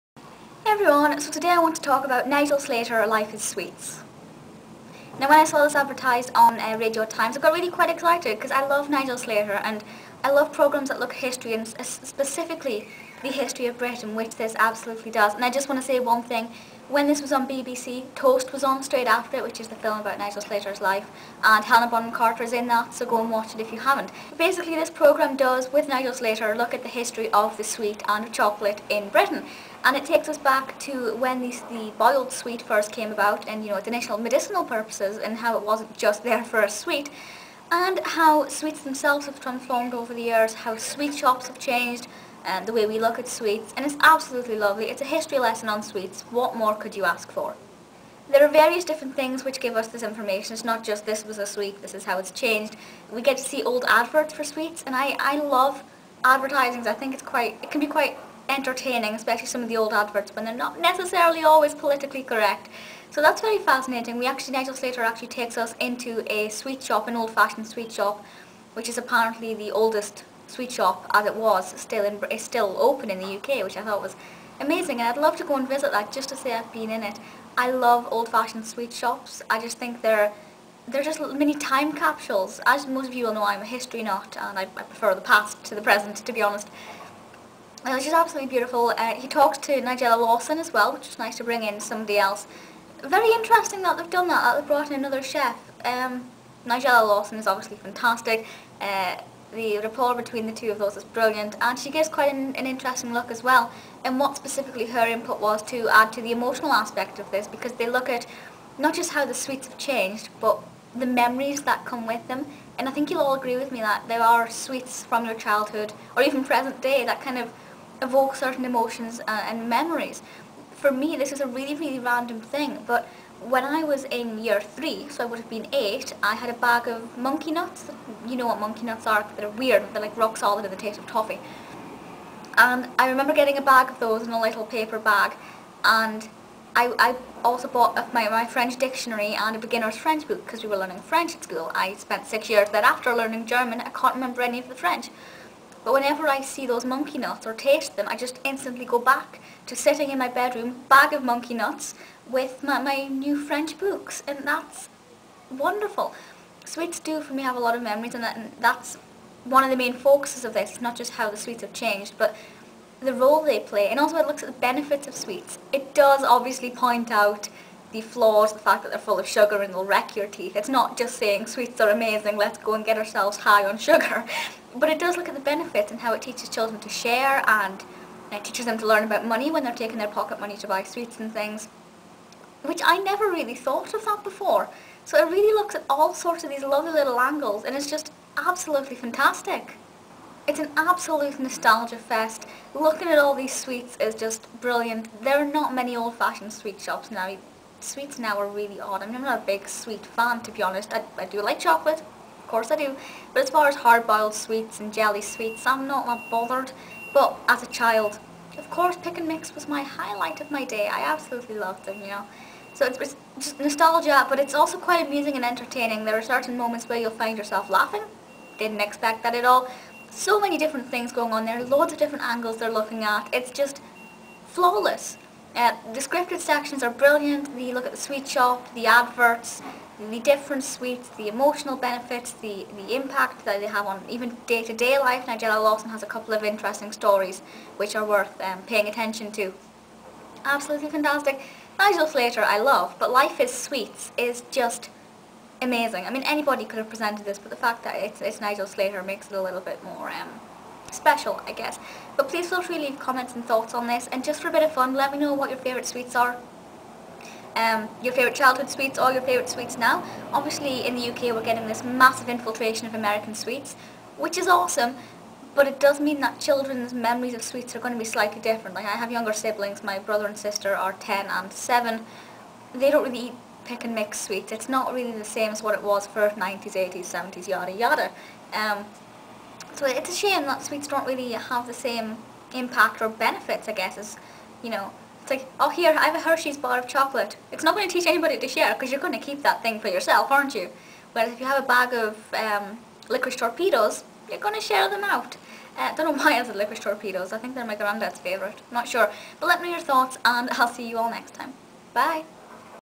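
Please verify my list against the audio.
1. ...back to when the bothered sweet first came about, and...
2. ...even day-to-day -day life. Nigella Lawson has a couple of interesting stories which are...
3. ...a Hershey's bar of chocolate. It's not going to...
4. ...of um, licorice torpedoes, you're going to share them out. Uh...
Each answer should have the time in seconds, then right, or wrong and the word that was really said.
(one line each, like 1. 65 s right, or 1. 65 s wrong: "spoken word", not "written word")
1. 30 s wrong: "boiled", not "bothered"
2. 234 s right
3. 286 s right
4. 291 s right.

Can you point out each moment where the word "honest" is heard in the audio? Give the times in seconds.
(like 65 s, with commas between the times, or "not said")
86 s, 200 s.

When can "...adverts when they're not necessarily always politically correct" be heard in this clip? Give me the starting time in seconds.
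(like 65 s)
59 s.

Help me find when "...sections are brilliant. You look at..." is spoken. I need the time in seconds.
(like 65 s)
226 s.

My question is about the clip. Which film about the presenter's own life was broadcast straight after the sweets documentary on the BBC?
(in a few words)
Toast.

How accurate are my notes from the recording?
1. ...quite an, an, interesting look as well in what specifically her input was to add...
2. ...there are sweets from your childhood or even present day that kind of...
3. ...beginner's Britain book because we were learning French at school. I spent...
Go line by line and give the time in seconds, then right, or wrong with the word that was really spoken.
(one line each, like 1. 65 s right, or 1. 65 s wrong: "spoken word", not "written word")
1. 102 s right
2. 114 s right
3. 139 s wrong: "French", not "Britain".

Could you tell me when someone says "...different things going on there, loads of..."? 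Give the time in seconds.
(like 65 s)
220 s.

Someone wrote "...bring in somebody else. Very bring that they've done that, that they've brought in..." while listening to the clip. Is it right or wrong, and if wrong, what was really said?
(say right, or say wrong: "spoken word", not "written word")
wrong: "interesting", not "bring".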